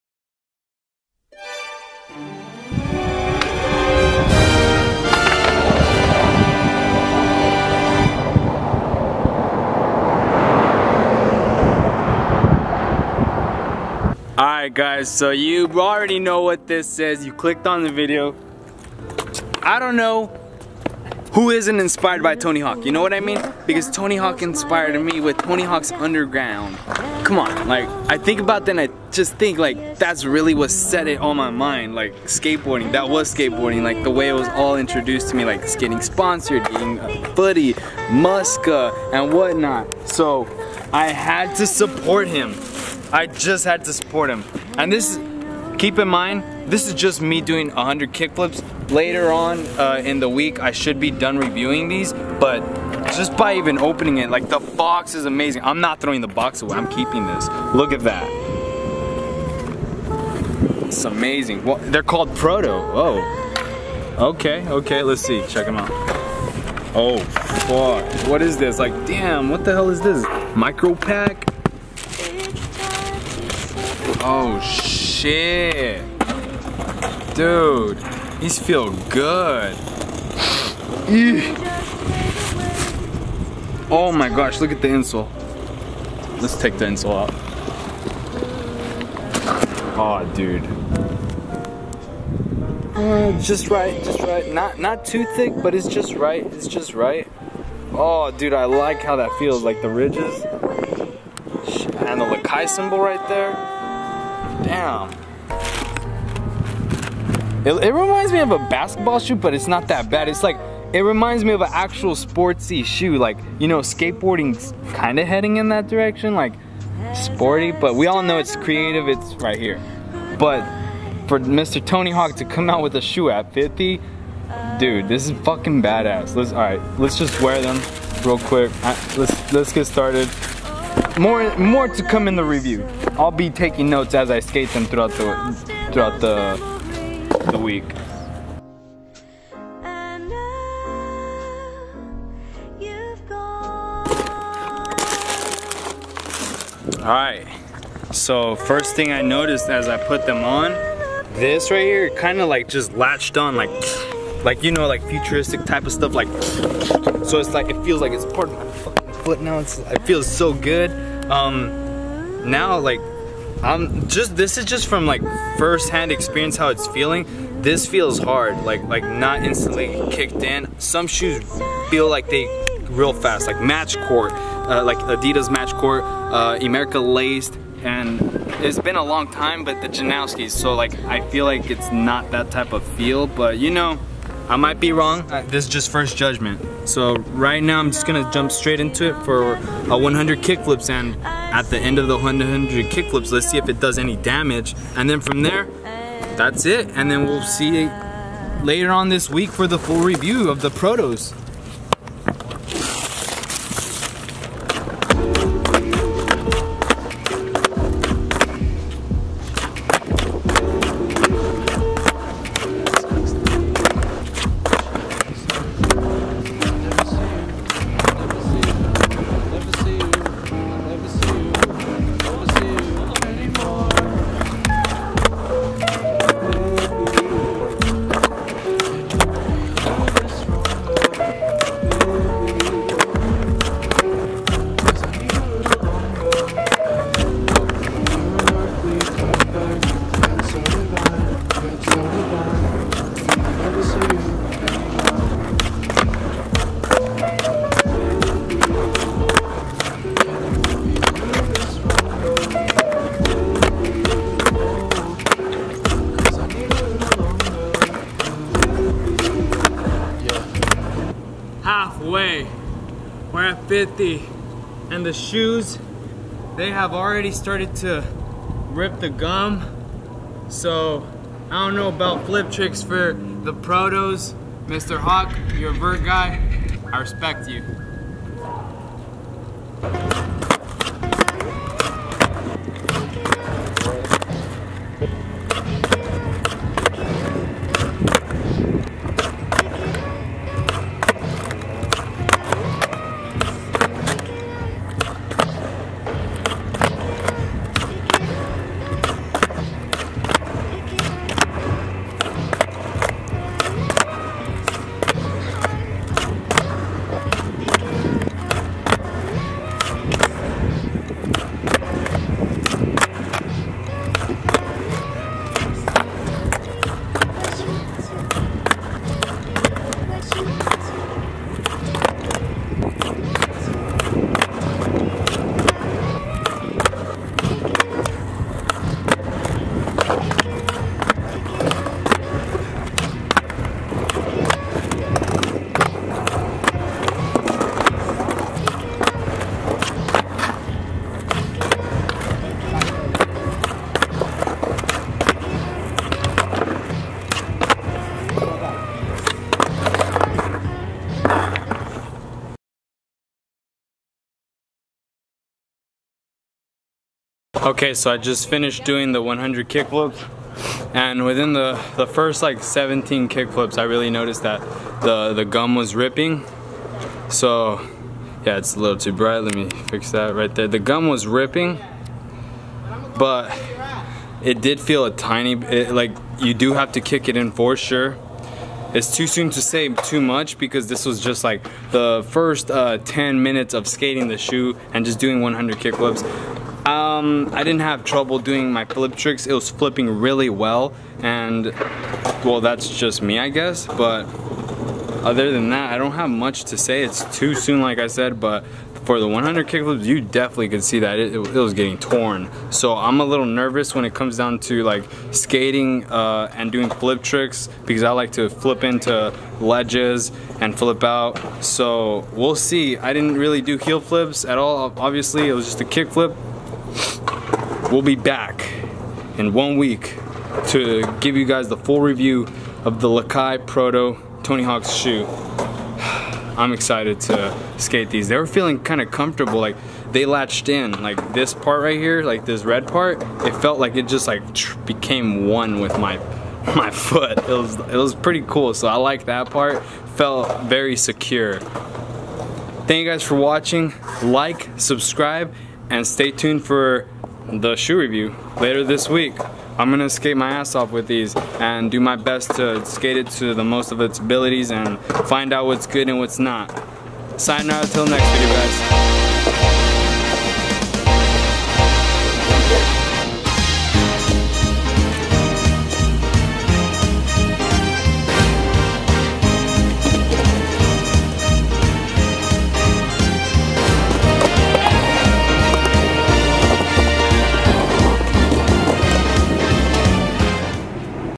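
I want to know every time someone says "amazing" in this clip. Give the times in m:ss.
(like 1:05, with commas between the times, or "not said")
0:55, 1:01.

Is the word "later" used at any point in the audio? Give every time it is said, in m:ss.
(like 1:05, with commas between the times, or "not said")
0:48, 3:18, 7:28.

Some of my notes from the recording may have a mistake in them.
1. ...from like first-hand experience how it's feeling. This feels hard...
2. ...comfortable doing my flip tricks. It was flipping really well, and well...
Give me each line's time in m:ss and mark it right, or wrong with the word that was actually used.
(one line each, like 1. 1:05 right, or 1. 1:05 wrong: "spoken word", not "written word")
1. 2:44 right
2. 6:28 wrong: "trouble", not "comfortable".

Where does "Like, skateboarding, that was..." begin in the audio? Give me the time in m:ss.
0:31.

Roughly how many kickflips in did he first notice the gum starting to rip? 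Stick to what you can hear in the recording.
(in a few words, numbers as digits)
17.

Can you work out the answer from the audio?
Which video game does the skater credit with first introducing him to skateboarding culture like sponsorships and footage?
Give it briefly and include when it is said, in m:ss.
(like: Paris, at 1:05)
Tony Hawk's Underground, at 0:25.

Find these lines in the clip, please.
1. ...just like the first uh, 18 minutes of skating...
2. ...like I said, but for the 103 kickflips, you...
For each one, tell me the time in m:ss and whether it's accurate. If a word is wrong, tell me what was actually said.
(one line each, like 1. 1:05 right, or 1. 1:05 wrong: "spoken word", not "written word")
1. 6:21 wrong: "10", not "18"
2. 6:37 wrong: "100", not "103".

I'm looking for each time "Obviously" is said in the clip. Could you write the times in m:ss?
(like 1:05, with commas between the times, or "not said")
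6:54.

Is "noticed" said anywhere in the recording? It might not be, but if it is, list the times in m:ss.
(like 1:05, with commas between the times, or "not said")
2:29, 6:04.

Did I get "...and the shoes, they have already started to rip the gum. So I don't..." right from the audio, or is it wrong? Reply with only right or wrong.
right.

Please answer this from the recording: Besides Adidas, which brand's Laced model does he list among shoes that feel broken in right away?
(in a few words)
Emerica.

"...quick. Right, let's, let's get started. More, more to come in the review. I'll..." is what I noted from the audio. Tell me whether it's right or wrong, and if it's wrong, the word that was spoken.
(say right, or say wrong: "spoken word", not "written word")
right.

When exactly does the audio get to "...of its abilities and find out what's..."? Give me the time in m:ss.
7:33.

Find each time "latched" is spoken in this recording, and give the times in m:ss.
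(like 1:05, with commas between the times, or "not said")
2:32, 7:10.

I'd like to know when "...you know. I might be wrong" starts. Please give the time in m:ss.
3:03.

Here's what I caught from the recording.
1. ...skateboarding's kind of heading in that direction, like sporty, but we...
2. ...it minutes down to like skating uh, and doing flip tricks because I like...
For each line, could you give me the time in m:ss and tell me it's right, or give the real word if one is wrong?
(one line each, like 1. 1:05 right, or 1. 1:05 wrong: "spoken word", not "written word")
1. 1:53 right
2. 6:44 wrong: "comes", not "minutes".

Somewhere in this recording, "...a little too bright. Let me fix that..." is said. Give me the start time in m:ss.
6:08.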